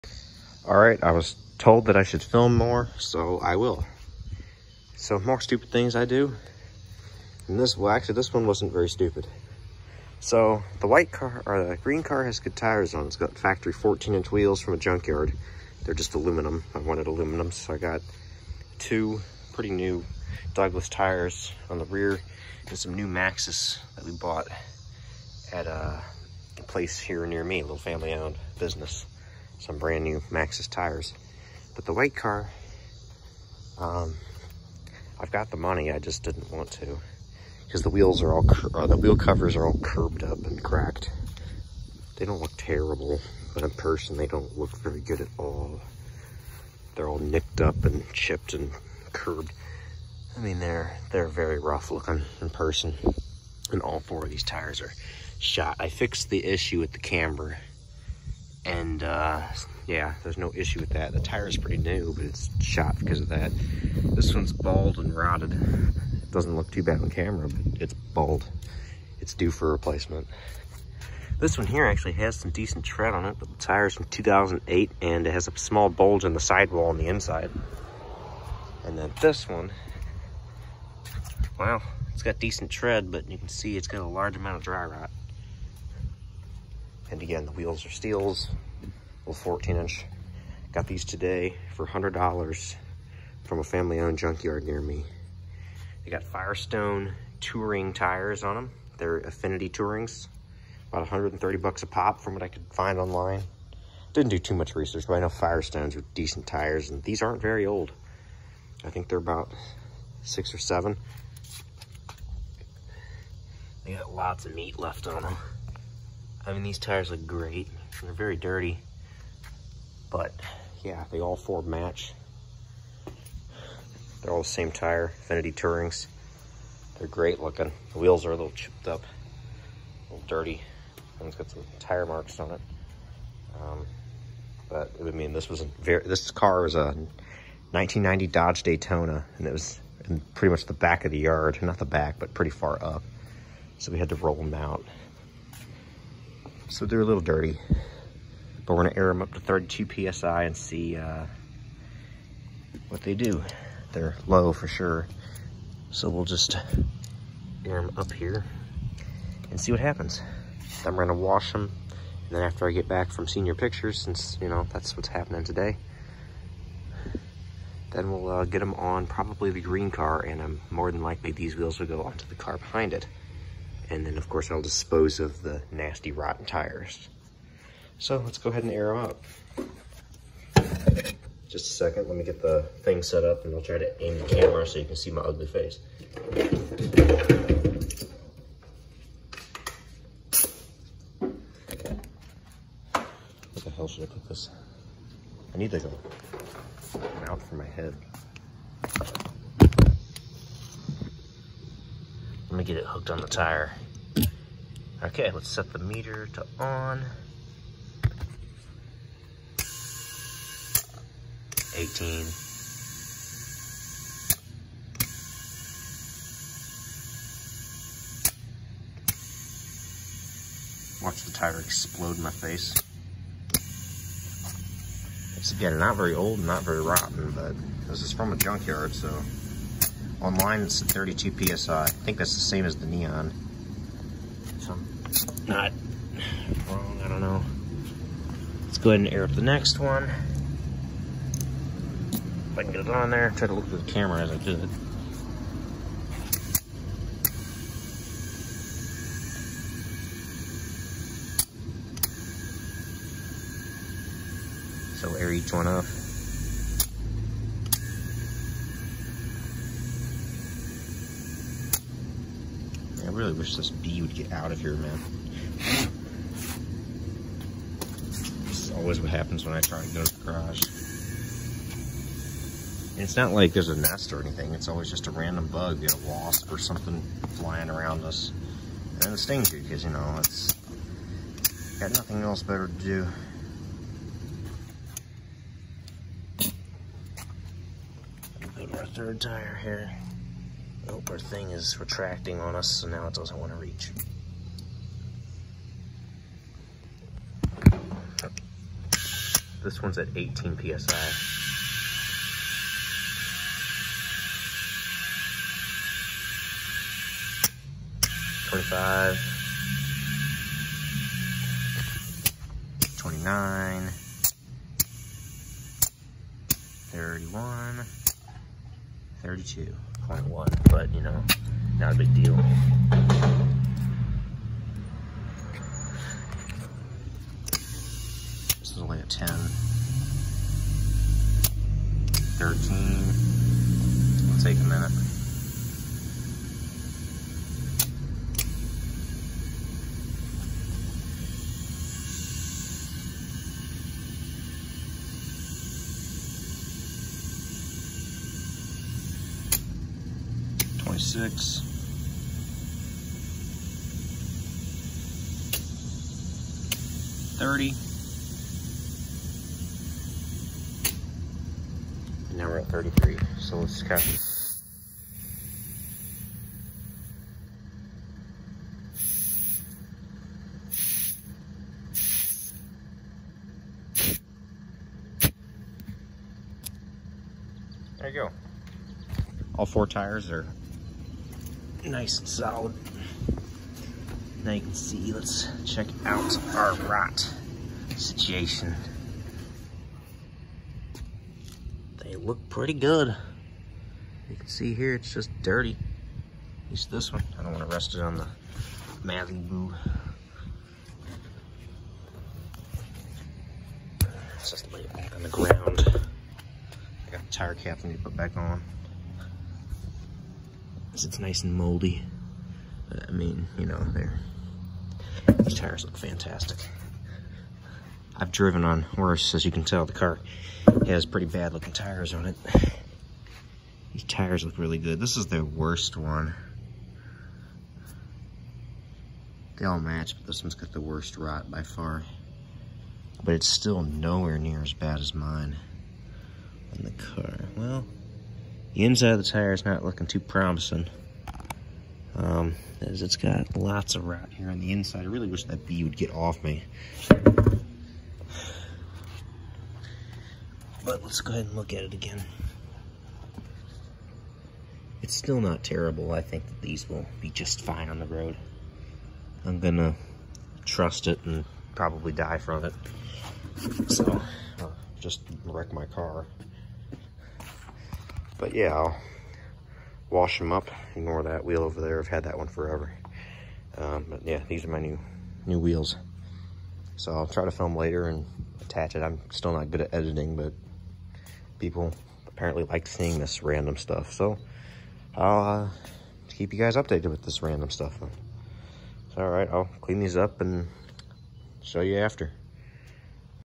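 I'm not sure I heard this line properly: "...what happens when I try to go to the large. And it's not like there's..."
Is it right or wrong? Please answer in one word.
wrong.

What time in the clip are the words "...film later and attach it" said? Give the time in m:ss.
7:57.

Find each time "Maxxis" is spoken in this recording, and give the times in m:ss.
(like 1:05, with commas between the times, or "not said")
0:23, 0:30.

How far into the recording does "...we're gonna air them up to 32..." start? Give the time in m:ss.
2:28.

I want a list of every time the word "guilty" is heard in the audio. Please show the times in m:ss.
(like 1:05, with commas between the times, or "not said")
not said.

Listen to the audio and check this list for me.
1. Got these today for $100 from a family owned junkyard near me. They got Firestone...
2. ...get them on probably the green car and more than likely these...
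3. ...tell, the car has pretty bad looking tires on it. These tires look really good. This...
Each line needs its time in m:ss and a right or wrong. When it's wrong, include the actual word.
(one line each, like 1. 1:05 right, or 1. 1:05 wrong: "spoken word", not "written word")
1. 1:30 right
2. 2:48 right
3. 6:59 right.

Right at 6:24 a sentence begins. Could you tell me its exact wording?
Now you can see, let's check out our rot situation.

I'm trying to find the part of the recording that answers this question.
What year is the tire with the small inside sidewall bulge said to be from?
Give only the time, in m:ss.
1:14.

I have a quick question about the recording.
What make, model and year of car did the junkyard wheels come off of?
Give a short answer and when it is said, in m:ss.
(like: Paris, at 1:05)
1990 Dodge Daytona, at 2:17.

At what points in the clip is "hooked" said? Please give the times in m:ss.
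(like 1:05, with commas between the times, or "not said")
3:22.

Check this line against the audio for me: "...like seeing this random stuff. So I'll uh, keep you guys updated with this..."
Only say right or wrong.
right.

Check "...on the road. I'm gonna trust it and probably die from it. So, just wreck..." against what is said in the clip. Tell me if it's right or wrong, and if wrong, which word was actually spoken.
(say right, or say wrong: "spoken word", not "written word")
right.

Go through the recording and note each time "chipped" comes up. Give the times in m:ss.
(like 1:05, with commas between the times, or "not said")
0:48, 2:08.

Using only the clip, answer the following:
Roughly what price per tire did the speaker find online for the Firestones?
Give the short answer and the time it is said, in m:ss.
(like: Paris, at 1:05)
$130, at 1:41.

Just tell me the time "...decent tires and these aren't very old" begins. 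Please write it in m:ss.
1:46.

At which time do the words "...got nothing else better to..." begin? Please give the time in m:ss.
4:41.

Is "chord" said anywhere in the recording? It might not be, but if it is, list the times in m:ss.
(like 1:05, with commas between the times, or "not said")
not said.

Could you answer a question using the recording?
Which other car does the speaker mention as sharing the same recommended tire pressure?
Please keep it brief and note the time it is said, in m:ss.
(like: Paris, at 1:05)
Neon, at 3:52.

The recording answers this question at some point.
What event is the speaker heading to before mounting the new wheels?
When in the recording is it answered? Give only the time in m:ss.
2:43.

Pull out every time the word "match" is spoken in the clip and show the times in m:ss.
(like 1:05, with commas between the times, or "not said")
2:01, 7:09.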